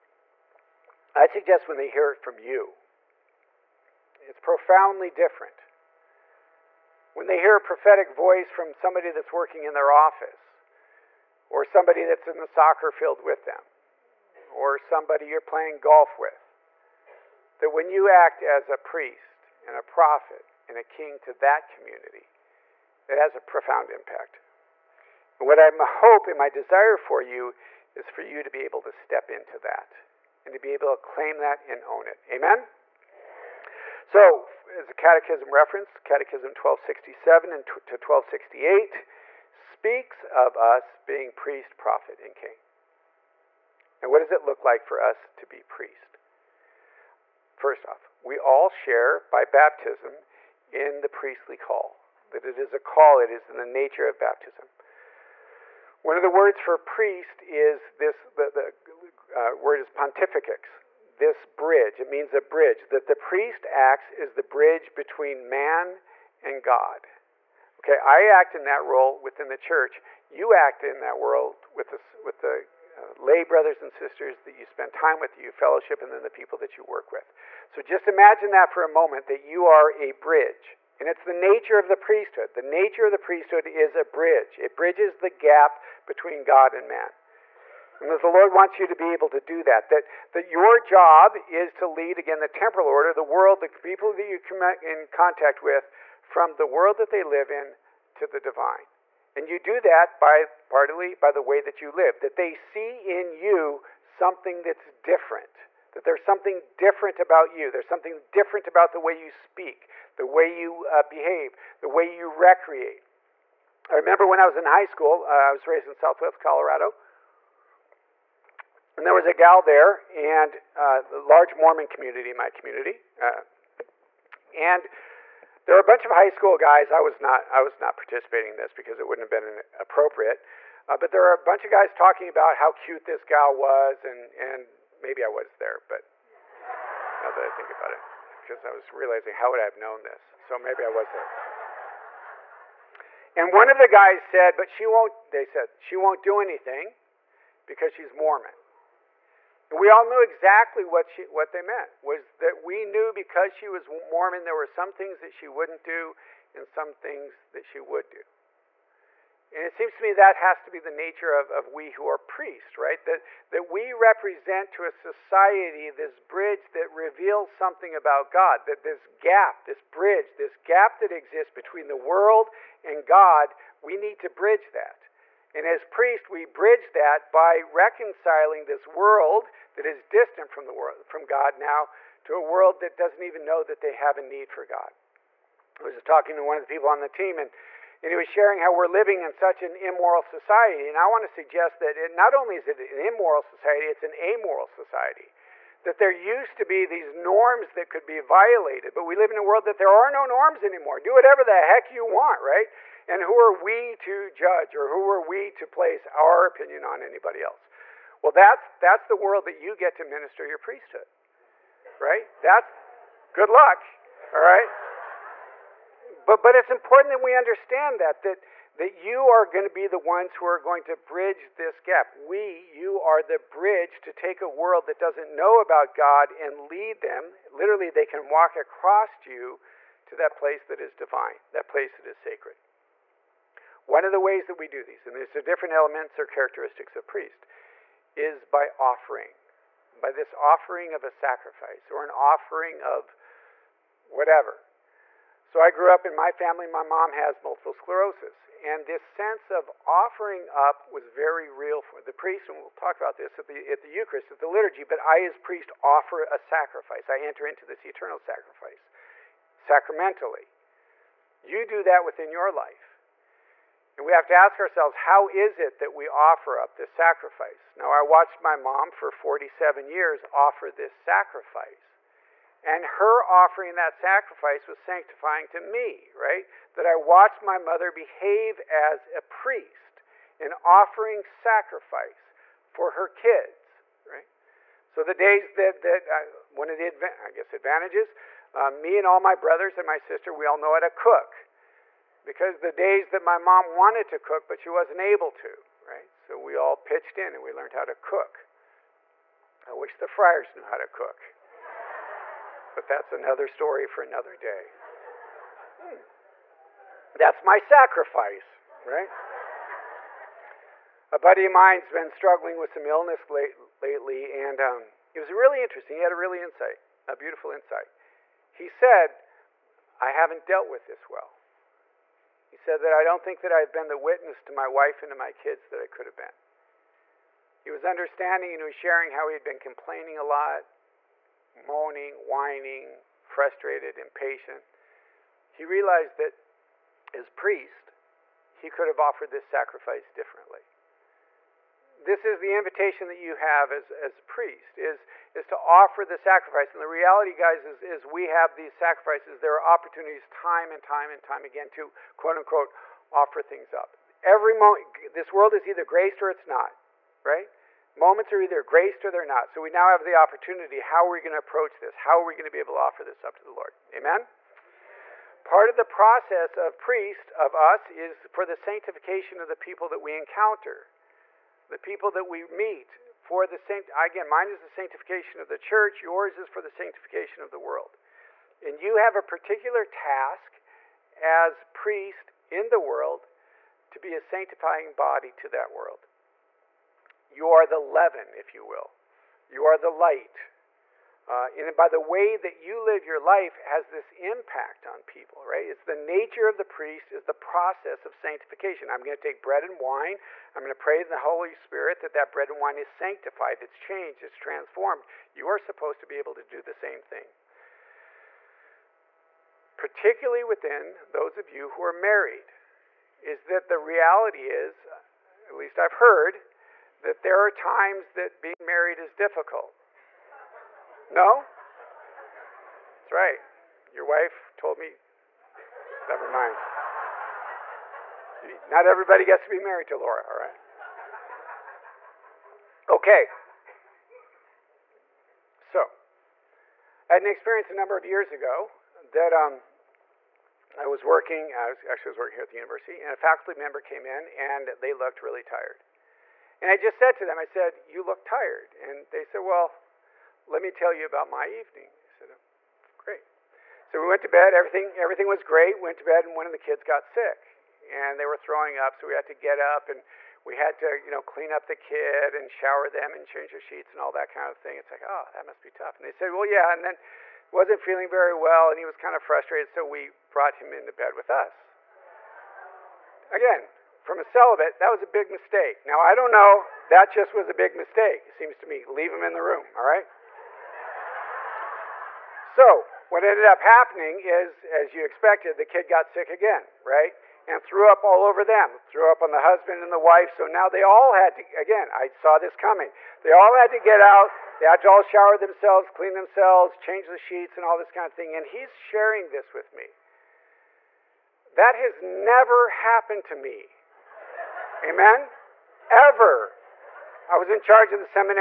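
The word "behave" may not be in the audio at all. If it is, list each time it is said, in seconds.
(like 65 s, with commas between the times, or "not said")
111 s, 277 s.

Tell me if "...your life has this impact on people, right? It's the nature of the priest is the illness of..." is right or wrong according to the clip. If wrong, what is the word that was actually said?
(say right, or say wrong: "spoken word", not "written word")
wrong: "process", not "illness".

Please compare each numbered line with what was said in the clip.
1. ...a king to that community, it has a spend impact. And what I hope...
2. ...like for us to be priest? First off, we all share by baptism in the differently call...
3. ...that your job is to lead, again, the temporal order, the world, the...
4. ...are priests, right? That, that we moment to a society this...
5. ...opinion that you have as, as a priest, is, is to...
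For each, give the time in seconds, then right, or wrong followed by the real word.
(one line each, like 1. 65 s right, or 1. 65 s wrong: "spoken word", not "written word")
1. 20 s wrong: "profound", not "spend"
2. 44 s wrong: "priestly", not "differently"
3. 90 s right
4. 162 s wrong: "represent", not "moment"
5. 342 s wrong: "invitation", not "opinion".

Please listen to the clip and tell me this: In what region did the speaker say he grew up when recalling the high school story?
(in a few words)
Southwest Colorado.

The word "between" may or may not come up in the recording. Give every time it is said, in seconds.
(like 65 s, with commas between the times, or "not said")
64 s, 86 s, 171 s.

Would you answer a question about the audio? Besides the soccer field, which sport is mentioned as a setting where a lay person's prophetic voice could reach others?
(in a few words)
golf.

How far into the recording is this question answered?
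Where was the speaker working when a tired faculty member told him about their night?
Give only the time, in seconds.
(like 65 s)
442 s.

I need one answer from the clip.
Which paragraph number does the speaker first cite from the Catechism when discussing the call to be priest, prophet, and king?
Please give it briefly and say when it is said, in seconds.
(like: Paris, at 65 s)
1267, at 36 s.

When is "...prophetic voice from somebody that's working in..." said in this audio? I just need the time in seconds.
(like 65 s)
7 s.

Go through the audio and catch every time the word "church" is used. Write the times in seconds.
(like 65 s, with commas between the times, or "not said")
69 s, 375 s.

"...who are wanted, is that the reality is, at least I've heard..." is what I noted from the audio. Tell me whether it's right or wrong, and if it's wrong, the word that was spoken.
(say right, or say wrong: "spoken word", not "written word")
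wrong: "married", not "wanted".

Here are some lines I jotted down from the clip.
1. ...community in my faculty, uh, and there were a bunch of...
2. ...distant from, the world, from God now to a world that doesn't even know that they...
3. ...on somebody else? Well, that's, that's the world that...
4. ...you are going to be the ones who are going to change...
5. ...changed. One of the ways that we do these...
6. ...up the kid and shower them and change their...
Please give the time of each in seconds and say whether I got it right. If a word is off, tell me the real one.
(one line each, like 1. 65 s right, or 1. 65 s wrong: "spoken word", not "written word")
1. 121 s wrong: "community", not "faculty"
2. 180 s right
3. 206 s wrong: "anybody", not "somebody"
4. 218 s wrong: "bridge", not "change"
5. 232 s wrong: "sacred", not "changed"
6. 461 s right.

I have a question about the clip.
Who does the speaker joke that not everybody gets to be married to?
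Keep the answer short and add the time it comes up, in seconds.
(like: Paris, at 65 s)
Laura, at 429 s.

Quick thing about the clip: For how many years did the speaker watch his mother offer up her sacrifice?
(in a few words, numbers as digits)
47.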